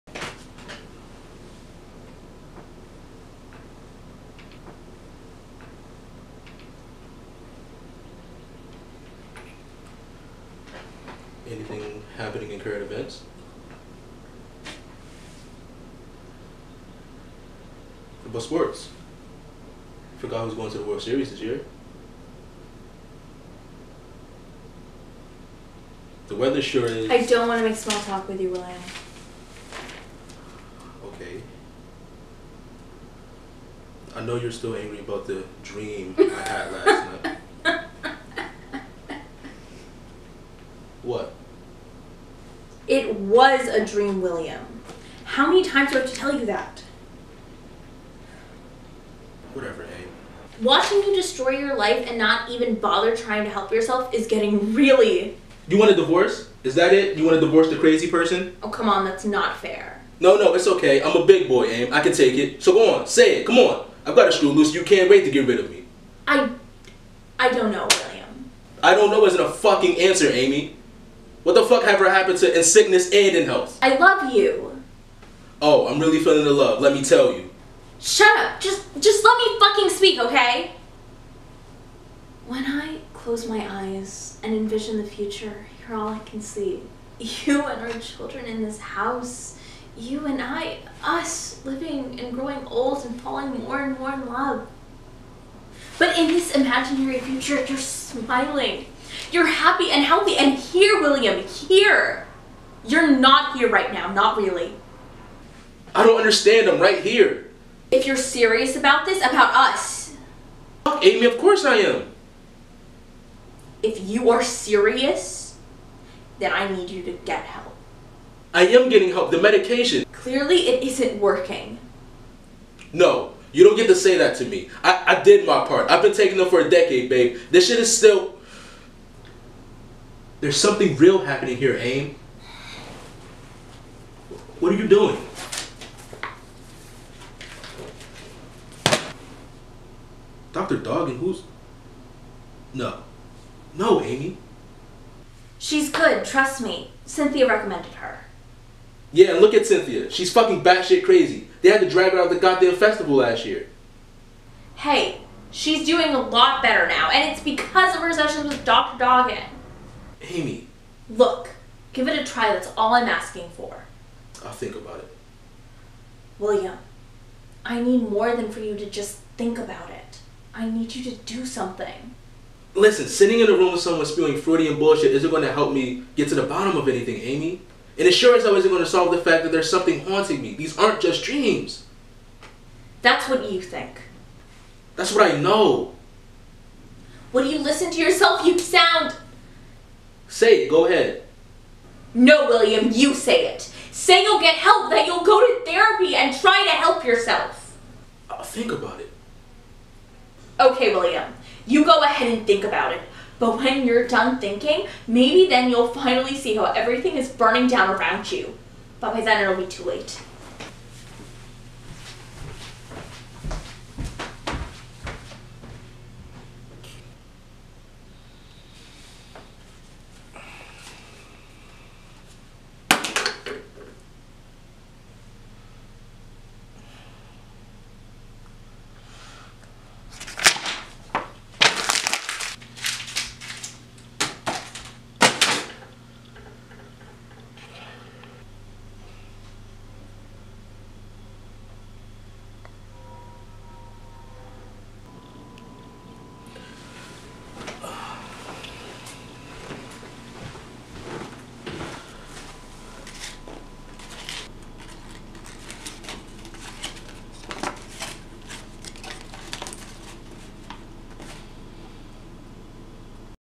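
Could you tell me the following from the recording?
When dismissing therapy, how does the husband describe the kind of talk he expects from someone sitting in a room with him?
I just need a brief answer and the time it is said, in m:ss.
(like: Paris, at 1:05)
Freudian, at 2:54.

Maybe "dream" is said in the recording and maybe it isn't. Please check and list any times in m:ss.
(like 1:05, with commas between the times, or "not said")
0:35, 0:43, 3:01.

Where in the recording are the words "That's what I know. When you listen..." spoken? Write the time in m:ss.
3:04.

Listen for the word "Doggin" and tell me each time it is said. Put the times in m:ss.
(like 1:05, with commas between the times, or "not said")
2:20, 2:38.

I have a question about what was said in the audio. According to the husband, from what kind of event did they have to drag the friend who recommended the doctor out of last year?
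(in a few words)
festival.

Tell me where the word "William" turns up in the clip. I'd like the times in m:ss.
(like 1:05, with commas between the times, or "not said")
0:28, 0:44, 1:07, 1:41, 2:46, 3:12, 3:20.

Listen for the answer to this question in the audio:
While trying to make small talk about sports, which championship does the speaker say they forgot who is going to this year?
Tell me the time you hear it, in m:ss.
0:20.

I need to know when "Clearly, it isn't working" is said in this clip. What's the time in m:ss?
2:00.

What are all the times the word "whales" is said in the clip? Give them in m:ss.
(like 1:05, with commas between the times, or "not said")
not said.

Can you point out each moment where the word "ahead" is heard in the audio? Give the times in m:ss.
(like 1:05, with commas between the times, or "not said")
3:10, 3:22.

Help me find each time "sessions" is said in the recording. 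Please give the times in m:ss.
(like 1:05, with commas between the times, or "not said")
2:38.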